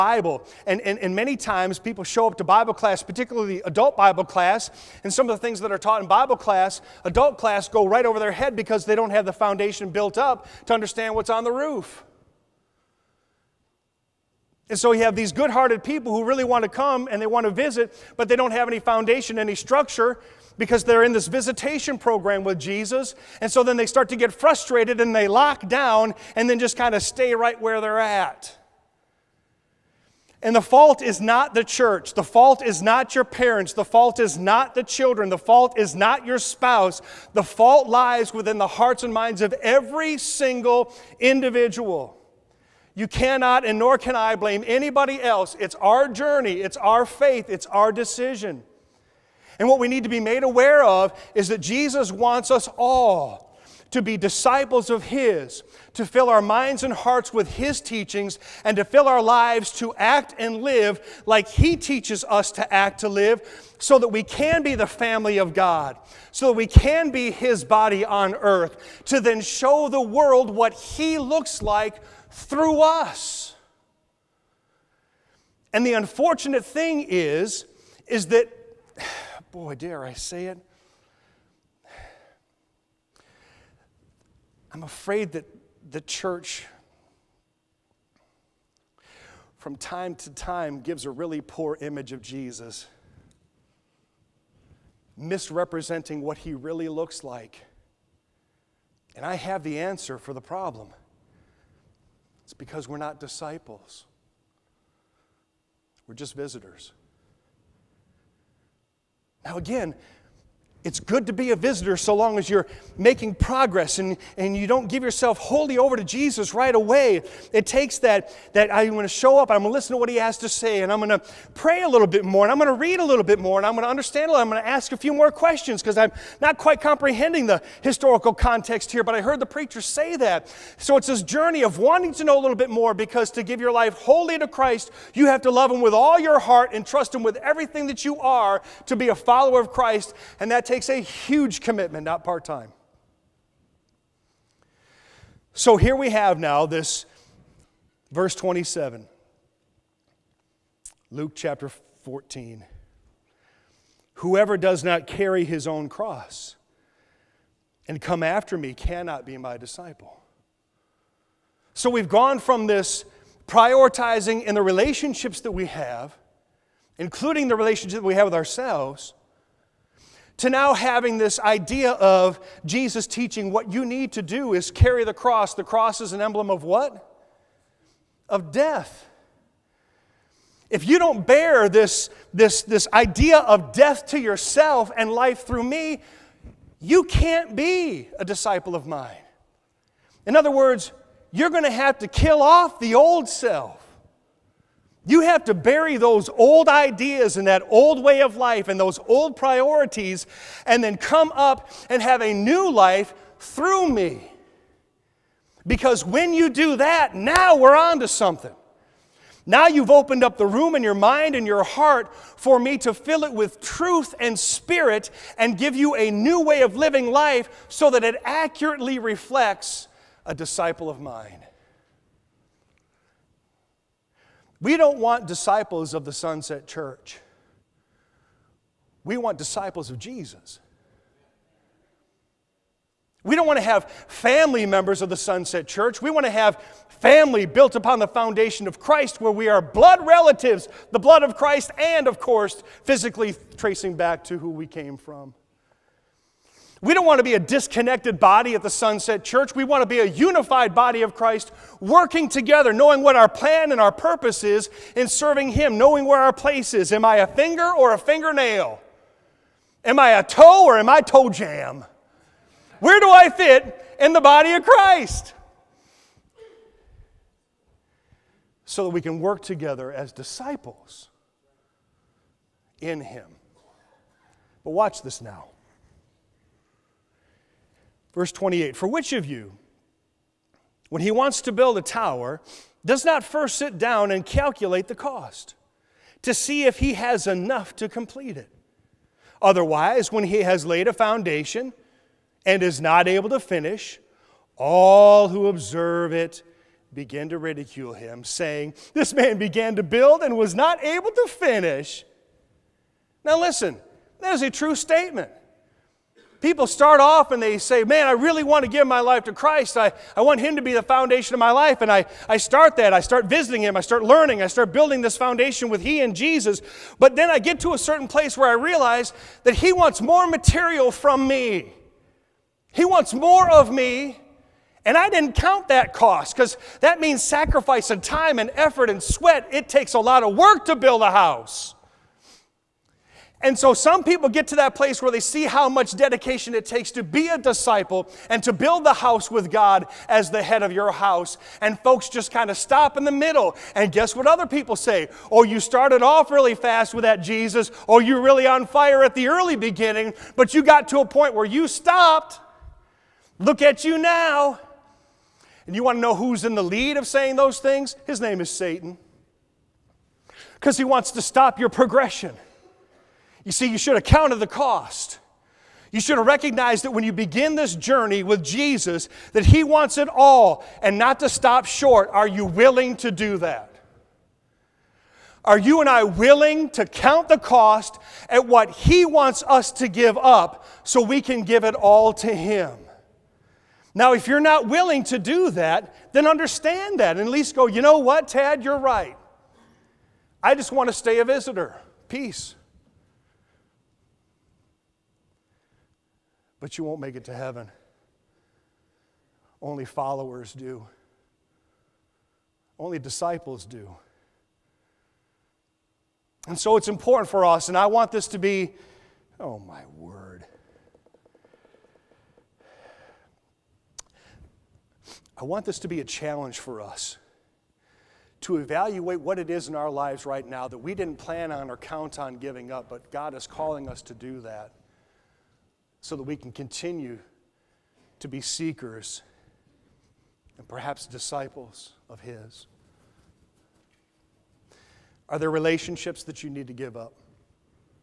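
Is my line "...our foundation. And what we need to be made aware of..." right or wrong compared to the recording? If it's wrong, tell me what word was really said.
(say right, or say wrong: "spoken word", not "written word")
wrong: "decision", not "foundation".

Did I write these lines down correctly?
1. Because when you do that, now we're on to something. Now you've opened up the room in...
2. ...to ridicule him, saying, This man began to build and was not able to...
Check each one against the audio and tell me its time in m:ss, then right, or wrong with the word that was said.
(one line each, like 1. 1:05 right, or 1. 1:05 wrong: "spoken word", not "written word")
1. 3:25 right
2. 4:57 right.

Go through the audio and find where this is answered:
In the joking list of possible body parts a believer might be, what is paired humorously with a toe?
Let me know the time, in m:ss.
4:21.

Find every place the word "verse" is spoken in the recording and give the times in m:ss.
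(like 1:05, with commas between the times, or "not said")
2:28, 4:38.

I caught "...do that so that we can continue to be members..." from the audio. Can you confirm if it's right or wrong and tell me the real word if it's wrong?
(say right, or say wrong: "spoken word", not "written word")
wrong: "seekers", not "members".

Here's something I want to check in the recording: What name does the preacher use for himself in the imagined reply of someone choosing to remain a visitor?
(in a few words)
Tad.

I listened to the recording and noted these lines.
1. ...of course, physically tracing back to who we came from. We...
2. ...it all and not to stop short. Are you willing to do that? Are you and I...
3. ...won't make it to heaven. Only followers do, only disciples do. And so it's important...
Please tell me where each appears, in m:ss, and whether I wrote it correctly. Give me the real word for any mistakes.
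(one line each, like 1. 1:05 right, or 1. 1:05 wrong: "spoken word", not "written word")
1. 4:02 right
2. 6:09 right
3. 6:36 right.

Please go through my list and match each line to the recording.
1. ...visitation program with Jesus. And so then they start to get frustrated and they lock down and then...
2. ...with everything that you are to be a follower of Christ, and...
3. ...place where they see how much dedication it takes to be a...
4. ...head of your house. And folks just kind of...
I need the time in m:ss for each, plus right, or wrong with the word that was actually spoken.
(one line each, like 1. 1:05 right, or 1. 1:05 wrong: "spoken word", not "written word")
1. 0:21 right
2. 2:17 right
3. 5:34 right
4. 5:40 right.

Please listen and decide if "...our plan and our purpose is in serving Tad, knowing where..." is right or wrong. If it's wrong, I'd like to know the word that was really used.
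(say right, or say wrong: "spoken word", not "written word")
wrong: "Him", not "Tad".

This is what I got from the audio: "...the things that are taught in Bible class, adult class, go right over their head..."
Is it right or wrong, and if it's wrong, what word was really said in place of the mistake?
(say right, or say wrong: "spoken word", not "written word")
right.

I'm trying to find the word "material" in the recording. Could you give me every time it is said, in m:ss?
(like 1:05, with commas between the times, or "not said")
5:20.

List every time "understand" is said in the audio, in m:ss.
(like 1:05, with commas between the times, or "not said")
0:10, 2:03, 6:26.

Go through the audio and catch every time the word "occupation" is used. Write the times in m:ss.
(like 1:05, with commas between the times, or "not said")
not said.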